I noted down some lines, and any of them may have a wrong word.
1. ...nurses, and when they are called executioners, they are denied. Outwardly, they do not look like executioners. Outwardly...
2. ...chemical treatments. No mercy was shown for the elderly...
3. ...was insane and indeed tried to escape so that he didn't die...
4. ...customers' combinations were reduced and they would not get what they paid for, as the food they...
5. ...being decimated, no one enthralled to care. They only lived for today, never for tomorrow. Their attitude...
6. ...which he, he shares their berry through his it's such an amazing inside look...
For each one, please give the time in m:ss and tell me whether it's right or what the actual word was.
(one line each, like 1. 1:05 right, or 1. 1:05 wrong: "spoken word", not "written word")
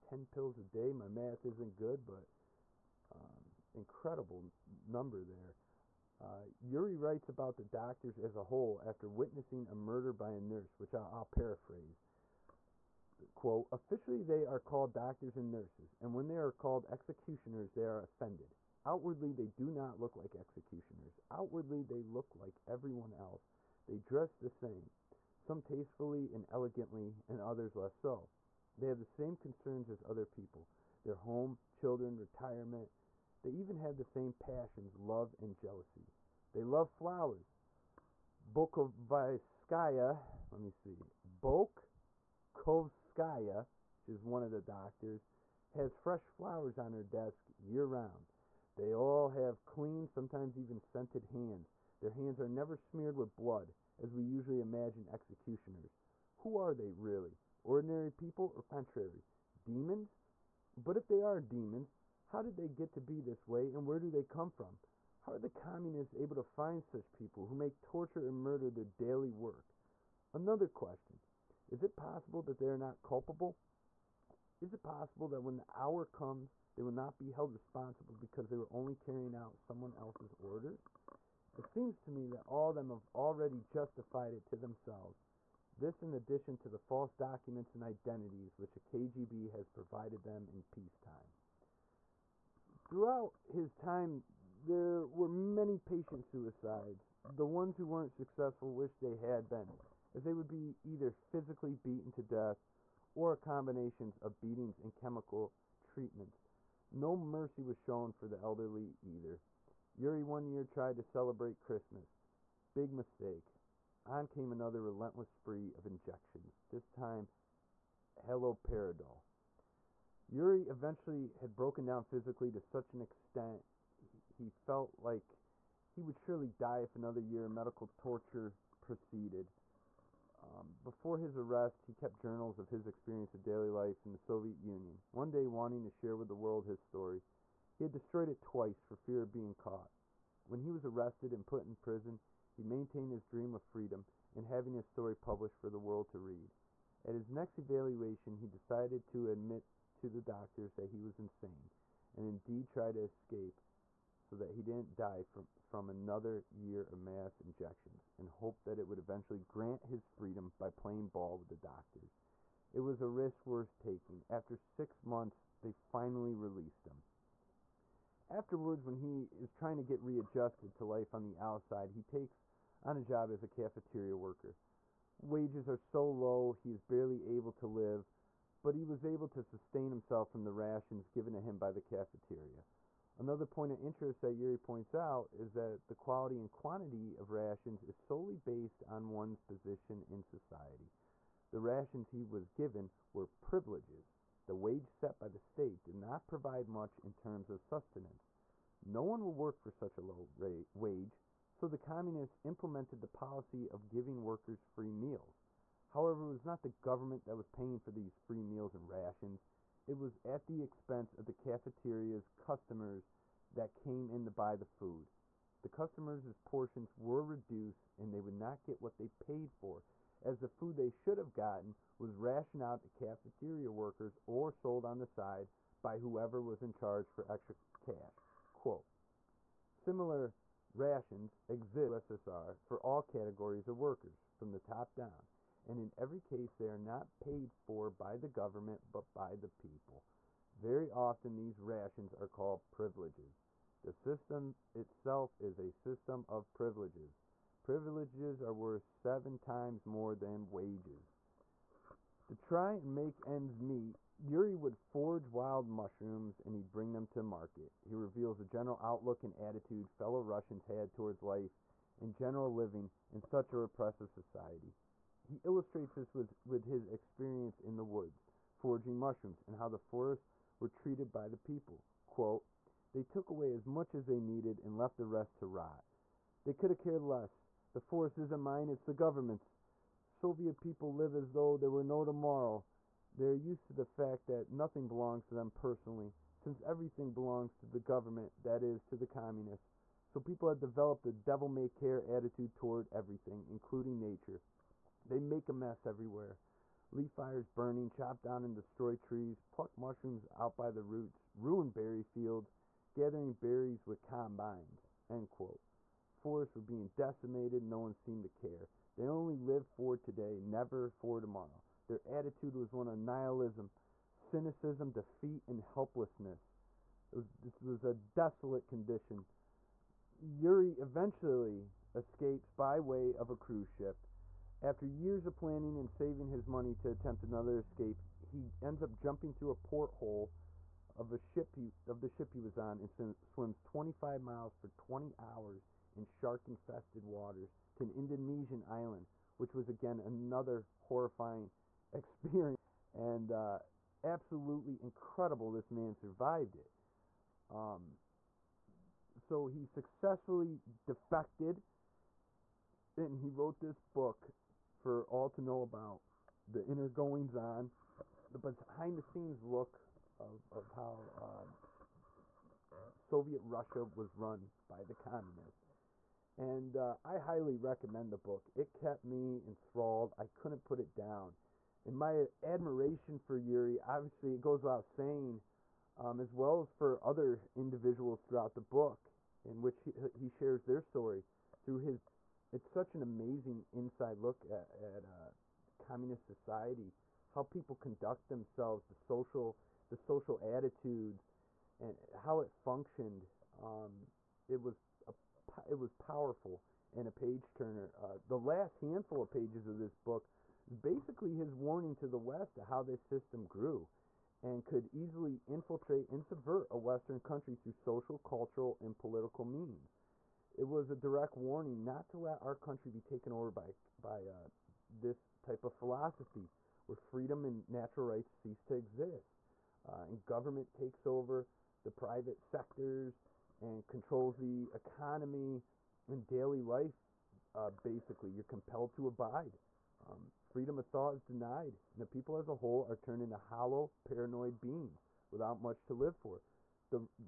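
1. 0:15 wrong: "offended", not "denied"
2. 1:44 right
3. 2:31 right
4. 3:35 wrong: "portions", not "combinations"
5. 5:06 wrong: "seemed", not "enthralled"
6. 6:19 wrong: "story", not "berry".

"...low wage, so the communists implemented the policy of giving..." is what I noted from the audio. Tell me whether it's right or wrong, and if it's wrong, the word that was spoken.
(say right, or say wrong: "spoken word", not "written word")
right.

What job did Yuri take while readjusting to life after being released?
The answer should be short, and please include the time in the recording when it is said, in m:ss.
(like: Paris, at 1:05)
cafeteria worker, at 2:53.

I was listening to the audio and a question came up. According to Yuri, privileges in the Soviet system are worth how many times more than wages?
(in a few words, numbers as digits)
7.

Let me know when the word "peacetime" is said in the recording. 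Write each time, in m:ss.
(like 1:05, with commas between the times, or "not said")
1:30.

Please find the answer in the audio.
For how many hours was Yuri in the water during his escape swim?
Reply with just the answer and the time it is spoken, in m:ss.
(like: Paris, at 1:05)
20, at 5:34.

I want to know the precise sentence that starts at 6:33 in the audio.
Um, it was a, it was powerful and a page turner.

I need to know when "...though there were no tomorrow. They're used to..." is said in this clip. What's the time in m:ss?
4:41.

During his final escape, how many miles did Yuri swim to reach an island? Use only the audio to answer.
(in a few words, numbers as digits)
25.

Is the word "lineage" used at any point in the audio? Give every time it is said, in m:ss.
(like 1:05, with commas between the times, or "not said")
not said.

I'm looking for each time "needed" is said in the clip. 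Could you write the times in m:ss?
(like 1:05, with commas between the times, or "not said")
4:34.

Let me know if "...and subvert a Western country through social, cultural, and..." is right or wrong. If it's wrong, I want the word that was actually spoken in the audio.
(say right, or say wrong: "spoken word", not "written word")
right.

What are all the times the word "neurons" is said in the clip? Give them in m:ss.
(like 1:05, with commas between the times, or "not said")
not said.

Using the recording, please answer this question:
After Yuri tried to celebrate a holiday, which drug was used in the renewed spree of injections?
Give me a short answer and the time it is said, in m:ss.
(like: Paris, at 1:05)
haloperidol, at 1:58.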